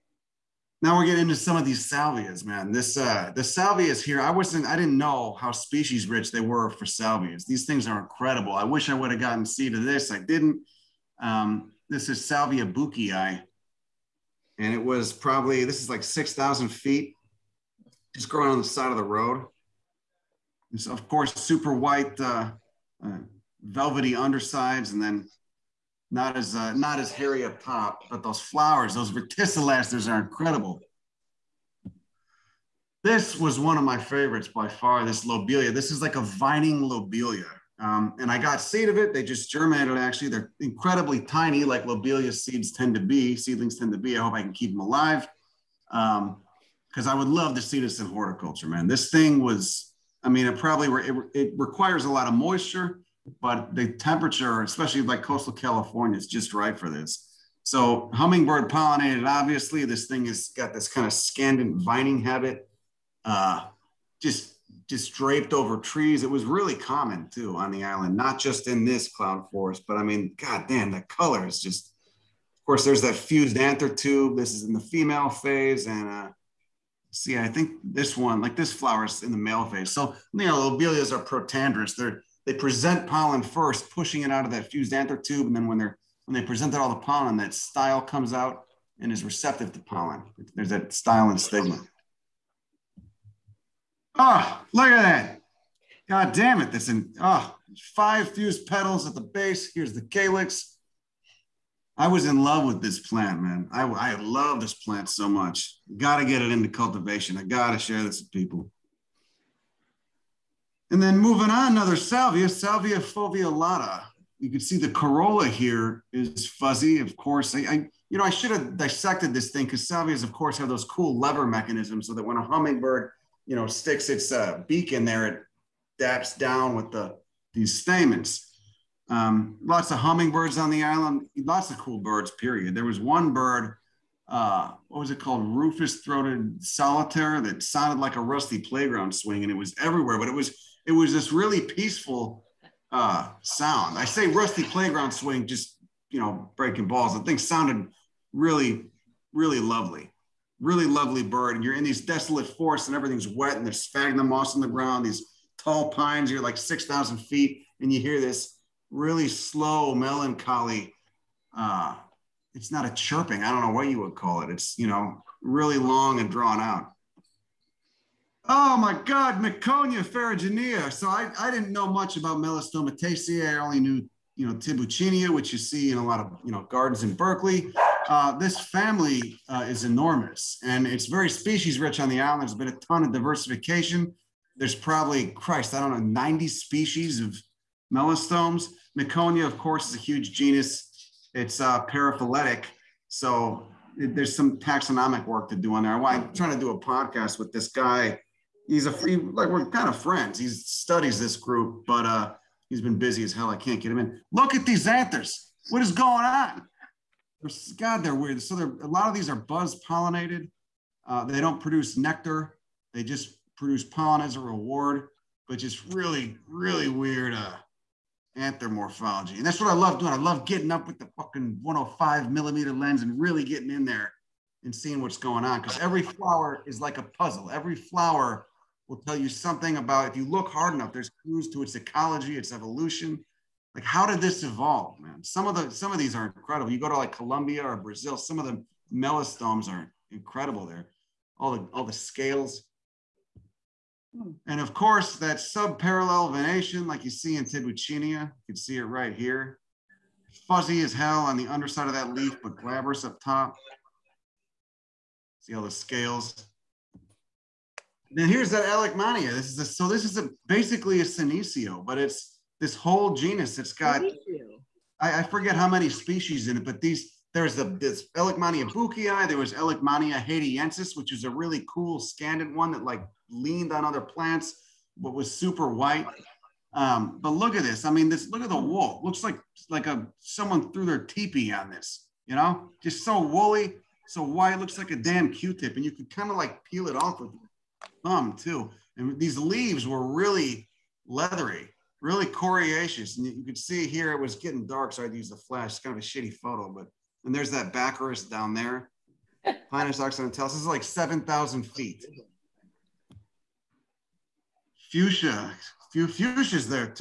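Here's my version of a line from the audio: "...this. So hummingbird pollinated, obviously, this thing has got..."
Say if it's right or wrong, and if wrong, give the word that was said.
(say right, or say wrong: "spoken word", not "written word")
right.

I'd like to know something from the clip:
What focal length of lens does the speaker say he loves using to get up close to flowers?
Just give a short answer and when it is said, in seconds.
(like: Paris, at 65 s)
105 millimeter, at 221 s.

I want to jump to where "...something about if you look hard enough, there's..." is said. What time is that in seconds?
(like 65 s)
229 s.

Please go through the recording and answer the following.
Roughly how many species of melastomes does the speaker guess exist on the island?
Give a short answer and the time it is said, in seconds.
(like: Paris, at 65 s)
90, at 186 s.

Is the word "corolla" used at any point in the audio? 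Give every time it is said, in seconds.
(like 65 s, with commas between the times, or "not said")
114 s.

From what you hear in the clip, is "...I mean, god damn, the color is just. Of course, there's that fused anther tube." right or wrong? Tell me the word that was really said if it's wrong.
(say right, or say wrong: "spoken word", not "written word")
right.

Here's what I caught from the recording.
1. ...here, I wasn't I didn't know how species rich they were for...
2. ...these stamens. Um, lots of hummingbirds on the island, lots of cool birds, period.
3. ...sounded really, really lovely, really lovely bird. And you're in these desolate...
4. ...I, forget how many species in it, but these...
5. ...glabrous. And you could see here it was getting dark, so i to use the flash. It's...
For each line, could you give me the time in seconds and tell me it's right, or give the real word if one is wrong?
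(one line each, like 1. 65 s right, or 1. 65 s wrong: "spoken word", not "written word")
1. 4 s right
2. 127 s right
3. 147 s right
4. 265 s right
5. 292 s wrong: "coriaceous", not "glabrous".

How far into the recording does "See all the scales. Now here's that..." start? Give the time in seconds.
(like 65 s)
255 s.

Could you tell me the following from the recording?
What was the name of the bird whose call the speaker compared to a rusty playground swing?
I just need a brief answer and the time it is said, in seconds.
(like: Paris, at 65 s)
Rufous throated solitaire, at 135 s.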